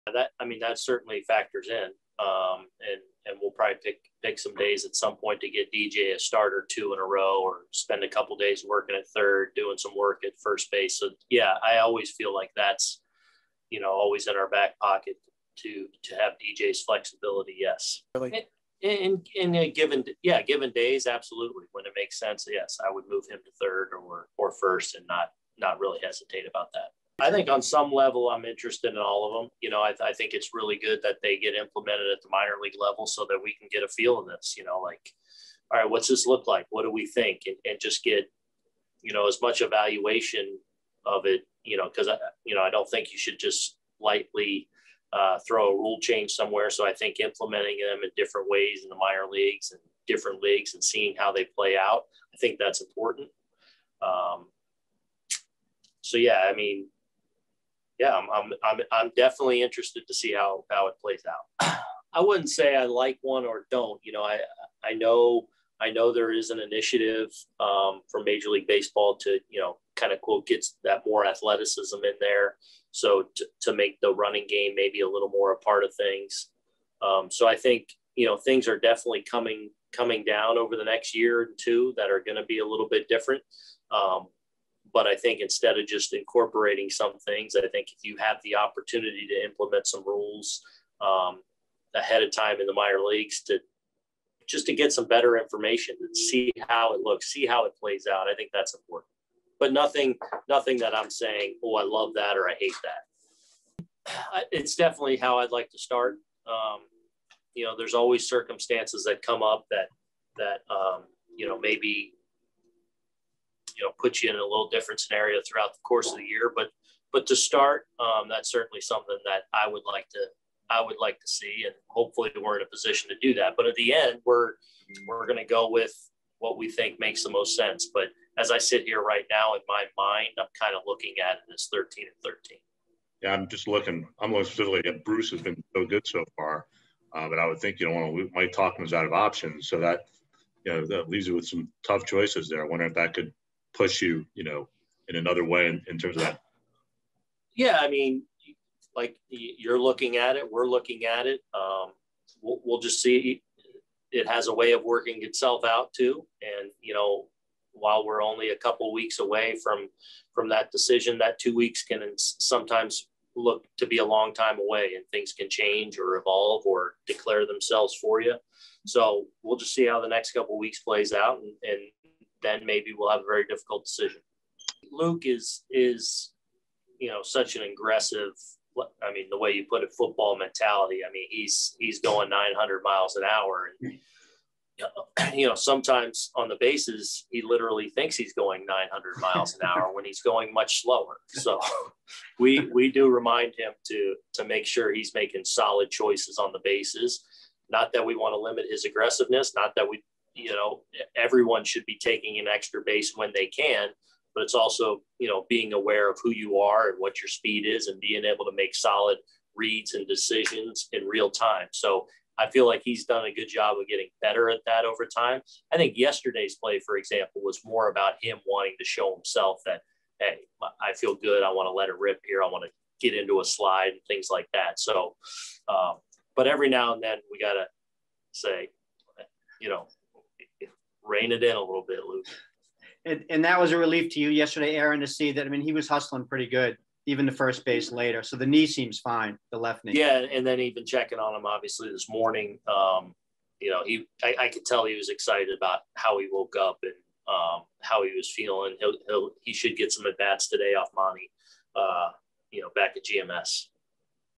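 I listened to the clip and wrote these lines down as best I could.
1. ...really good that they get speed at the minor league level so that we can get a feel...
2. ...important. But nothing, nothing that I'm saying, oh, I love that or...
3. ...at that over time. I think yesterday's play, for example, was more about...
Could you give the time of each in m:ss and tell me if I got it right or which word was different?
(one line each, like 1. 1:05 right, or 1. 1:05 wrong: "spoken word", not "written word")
1. 0:30 wrong: "implemented", not "speed"
2. 1:38 right
3. 3:34 right.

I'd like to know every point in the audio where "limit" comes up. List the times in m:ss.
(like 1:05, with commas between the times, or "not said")
3:18.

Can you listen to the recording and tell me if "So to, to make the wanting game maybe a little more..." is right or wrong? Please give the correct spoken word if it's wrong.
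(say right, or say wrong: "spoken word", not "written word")
wrong: "running", not "wanting".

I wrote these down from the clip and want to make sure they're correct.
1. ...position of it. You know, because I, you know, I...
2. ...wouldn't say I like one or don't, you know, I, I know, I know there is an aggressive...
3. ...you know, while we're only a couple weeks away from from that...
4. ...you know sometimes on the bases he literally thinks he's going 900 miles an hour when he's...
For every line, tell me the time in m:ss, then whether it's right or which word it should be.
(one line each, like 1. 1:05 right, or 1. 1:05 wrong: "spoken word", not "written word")
1. 0:39 wrong: "evaluation", not "position"
2. 1:02 wrong: "initiative", not "aggressive"
3. 2:36 right
4. 3:05 right.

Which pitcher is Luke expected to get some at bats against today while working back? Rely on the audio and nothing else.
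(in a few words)
Monty.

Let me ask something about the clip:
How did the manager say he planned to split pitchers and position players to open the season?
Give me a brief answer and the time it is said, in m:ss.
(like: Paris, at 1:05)
13 and 13, at 2:11.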